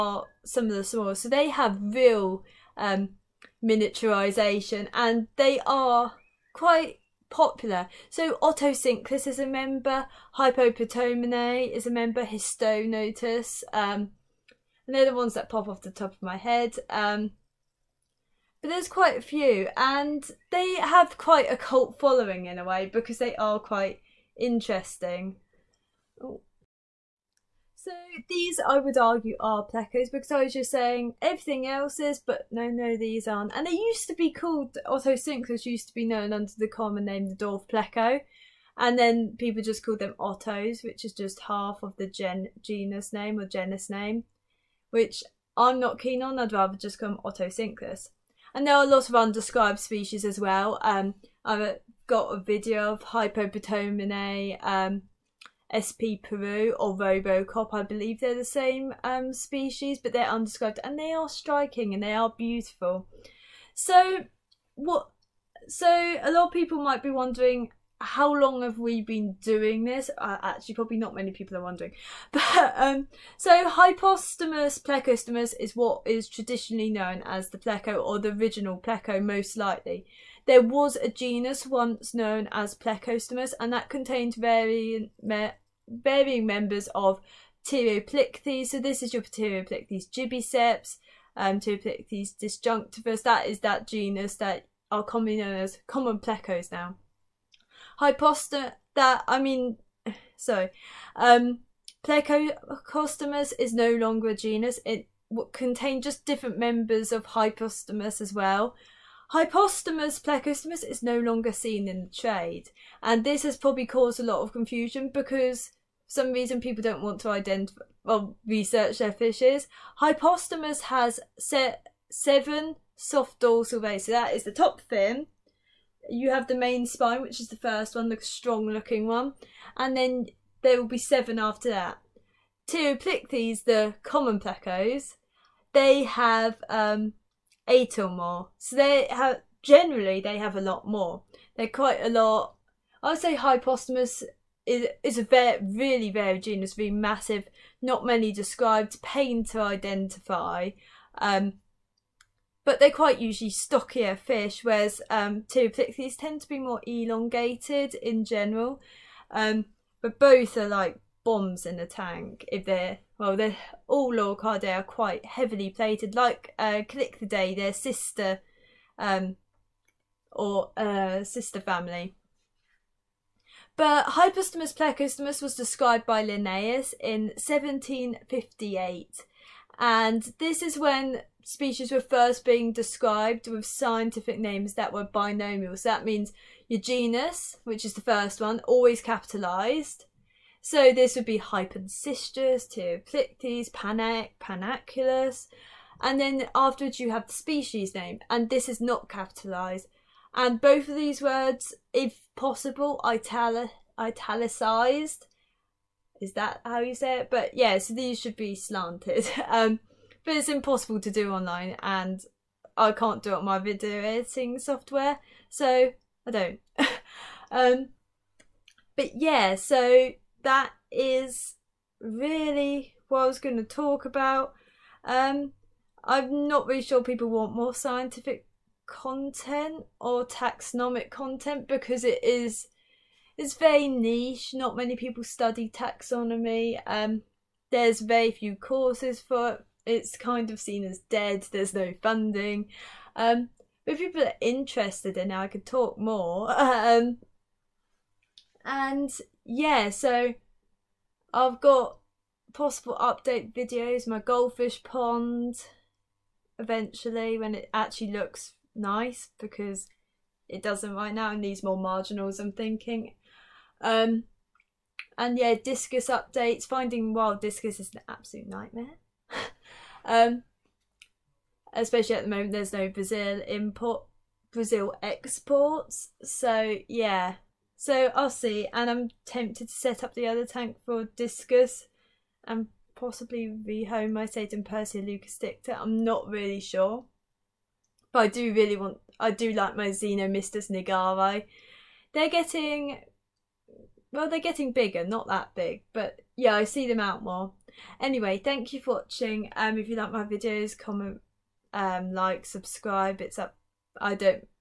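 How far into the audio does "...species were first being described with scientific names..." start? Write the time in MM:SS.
03:01.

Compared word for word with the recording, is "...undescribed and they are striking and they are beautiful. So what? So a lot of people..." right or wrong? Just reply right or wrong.
right.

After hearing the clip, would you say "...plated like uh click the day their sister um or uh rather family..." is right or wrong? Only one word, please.
wrong.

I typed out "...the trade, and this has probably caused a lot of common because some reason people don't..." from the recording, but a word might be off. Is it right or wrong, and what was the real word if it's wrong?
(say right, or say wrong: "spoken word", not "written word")
wrong: "confusion", not "common".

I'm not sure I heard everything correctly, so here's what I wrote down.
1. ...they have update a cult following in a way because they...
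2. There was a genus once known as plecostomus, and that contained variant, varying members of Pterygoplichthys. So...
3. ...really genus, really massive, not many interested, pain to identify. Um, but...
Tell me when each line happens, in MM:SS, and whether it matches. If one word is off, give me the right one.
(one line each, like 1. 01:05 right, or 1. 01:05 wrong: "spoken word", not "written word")
1. 00:20 wrong: "quite", not "update"
2. 01:20 right
3. 02:25 wrong: "described", not "interested".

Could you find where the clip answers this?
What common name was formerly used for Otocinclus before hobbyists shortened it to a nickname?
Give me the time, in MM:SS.
00:37.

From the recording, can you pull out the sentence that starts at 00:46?
I'd rather just call them Otocinclus.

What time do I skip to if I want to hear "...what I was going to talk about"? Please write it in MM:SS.
03:43.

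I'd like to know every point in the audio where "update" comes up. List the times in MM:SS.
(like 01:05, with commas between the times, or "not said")
04:12, 04:26.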